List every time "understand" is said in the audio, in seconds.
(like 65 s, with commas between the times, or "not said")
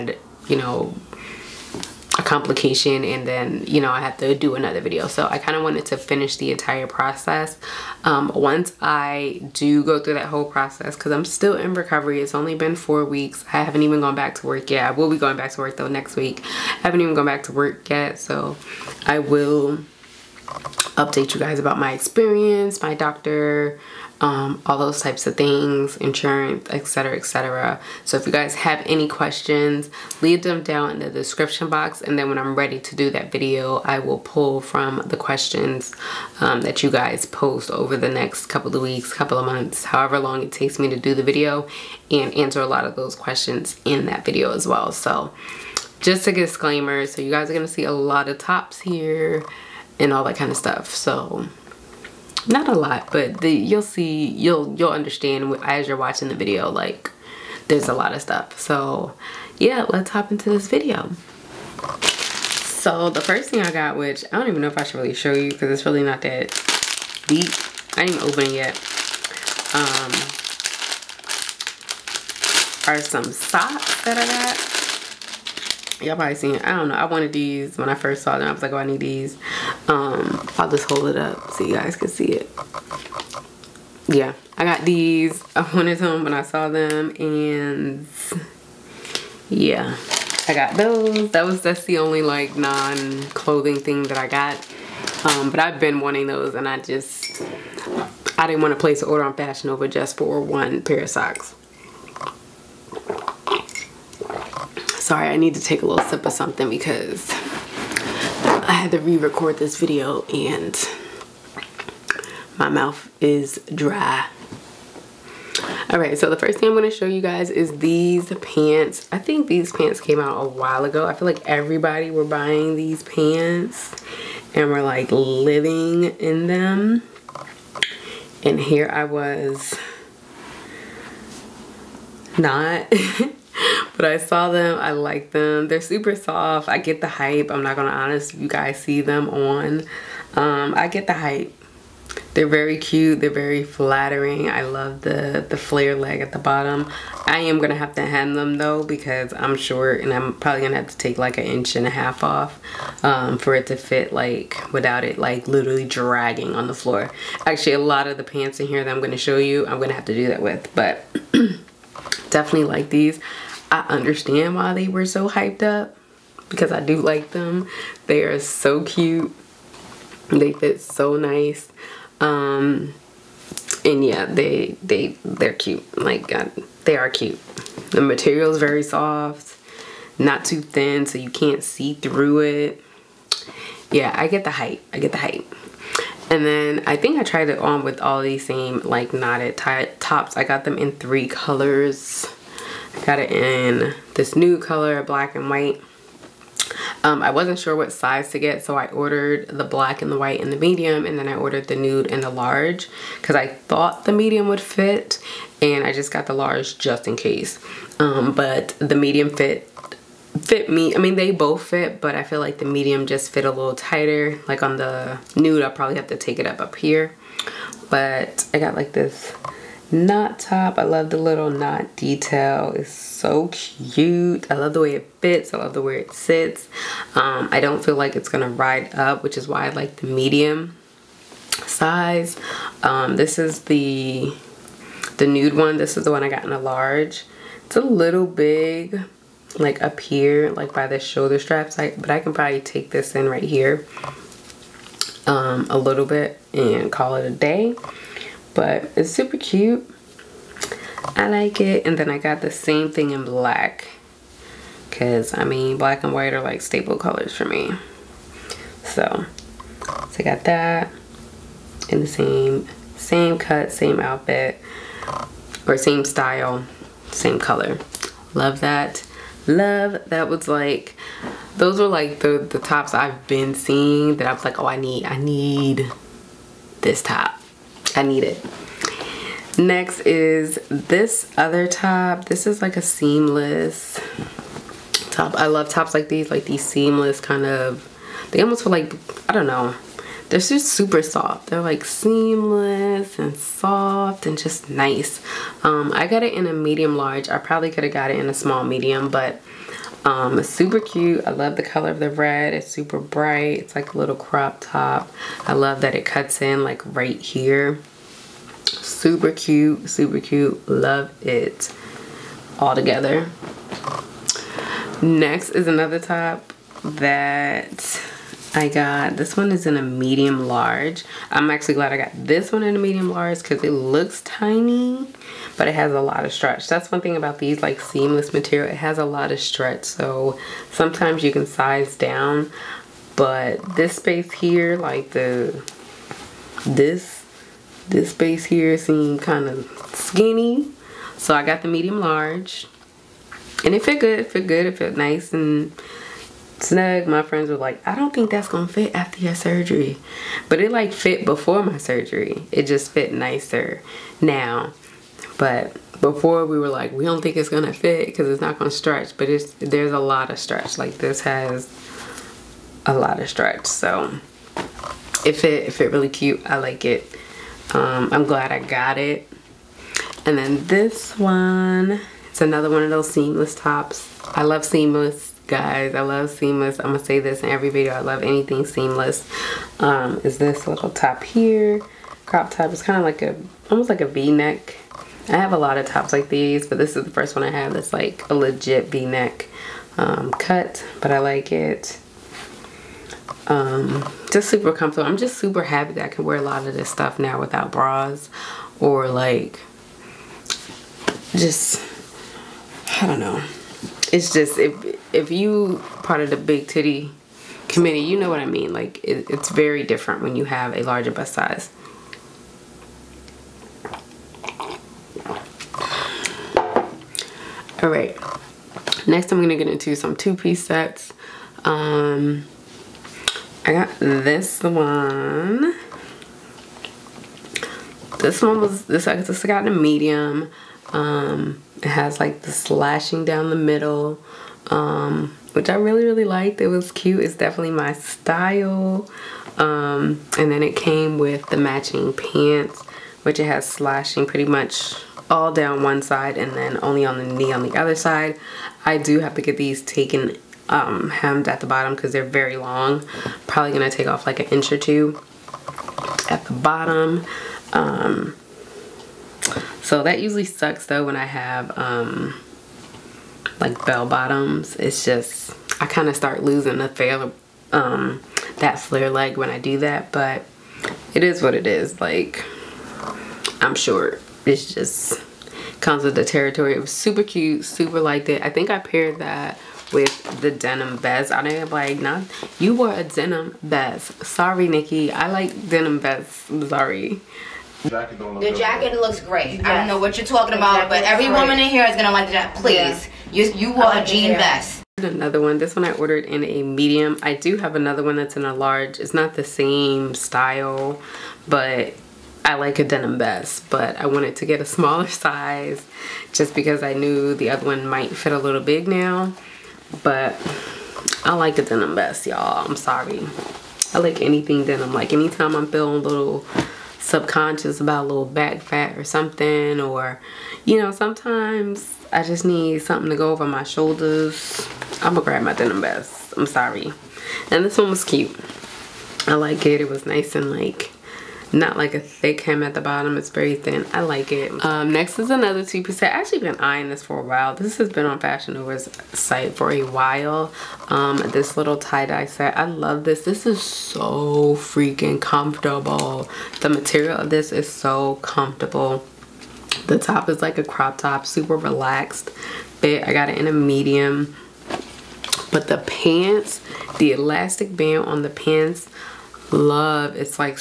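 54 s, 163 s.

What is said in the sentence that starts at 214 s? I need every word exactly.
Like on the nude, I'll probably have to take it up up here.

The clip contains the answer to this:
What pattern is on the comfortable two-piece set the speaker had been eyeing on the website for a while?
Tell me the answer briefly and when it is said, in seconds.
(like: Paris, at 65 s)
tie-dye, at 541 s.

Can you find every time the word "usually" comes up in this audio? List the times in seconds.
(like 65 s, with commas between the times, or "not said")
460 s.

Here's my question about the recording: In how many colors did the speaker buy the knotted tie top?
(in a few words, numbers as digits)
3.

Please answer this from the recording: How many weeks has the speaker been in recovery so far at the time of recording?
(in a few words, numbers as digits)
4.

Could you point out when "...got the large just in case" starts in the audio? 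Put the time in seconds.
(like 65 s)
206 s.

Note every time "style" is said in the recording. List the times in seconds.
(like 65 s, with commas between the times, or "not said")
266 s, 437 s, 500 s.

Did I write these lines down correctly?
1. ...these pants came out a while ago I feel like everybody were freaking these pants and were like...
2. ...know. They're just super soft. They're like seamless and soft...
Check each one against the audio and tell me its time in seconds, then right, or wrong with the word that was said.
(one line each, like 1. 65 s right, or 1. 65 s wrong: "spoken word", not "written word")
1. 119 s wrong: "buying", not "freaking"
2. 289 s right.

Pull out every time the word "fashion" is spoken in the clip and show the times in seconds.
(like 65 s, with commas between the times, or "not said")
99 s, 538 s.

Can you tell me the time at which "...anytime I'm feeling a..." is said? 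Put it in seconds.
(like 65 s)
515 s.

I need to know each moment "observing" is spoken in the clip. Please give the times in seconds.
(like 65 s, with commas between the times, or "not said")
not said.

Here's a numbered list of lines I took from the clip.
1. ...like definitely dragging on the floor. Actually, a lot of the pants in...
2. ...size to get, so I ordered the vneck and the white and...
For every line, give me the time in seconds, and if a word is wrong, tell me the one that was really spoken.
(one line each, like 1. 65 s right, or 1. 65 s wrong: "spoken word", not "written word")
1. 155 s wrong: "literally", not "definitely"
2. 197 s wrong: "black", not "vneck".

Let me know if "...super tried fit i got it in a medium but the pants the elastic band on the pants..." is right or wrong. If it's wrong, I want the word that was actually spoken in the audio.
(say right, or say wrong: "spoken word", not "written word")
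wrong: "relaxed", not "tried".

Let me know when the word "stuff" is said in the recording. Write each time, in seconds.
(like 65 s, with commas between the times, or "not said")
50 s, 58 s, 396 s.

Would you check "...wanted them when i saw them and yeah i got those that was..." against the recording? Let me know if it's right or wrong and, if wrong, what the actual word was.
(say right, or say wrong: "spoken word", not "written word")
right.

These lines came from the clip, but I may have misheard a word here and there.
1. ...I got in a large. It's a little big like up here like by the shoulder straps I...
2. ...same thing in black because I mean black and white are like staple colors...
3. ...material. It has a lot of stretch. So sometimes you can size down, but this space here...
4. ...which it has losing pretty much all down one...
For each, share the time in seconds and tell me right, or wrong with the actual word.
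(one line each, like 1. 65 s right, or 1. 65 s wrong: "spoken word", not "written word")
1. 236 s right
2. 252 s right
3. 328 s right
4. 443 s wrong: "slashing", not "losing".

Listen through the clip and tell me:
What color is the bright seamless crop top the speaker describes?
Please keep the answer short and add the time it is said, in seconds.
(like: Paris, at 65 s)
red, at 302 s.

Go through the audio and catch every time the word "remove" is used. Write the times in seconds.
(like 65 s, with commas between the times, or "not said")
not said.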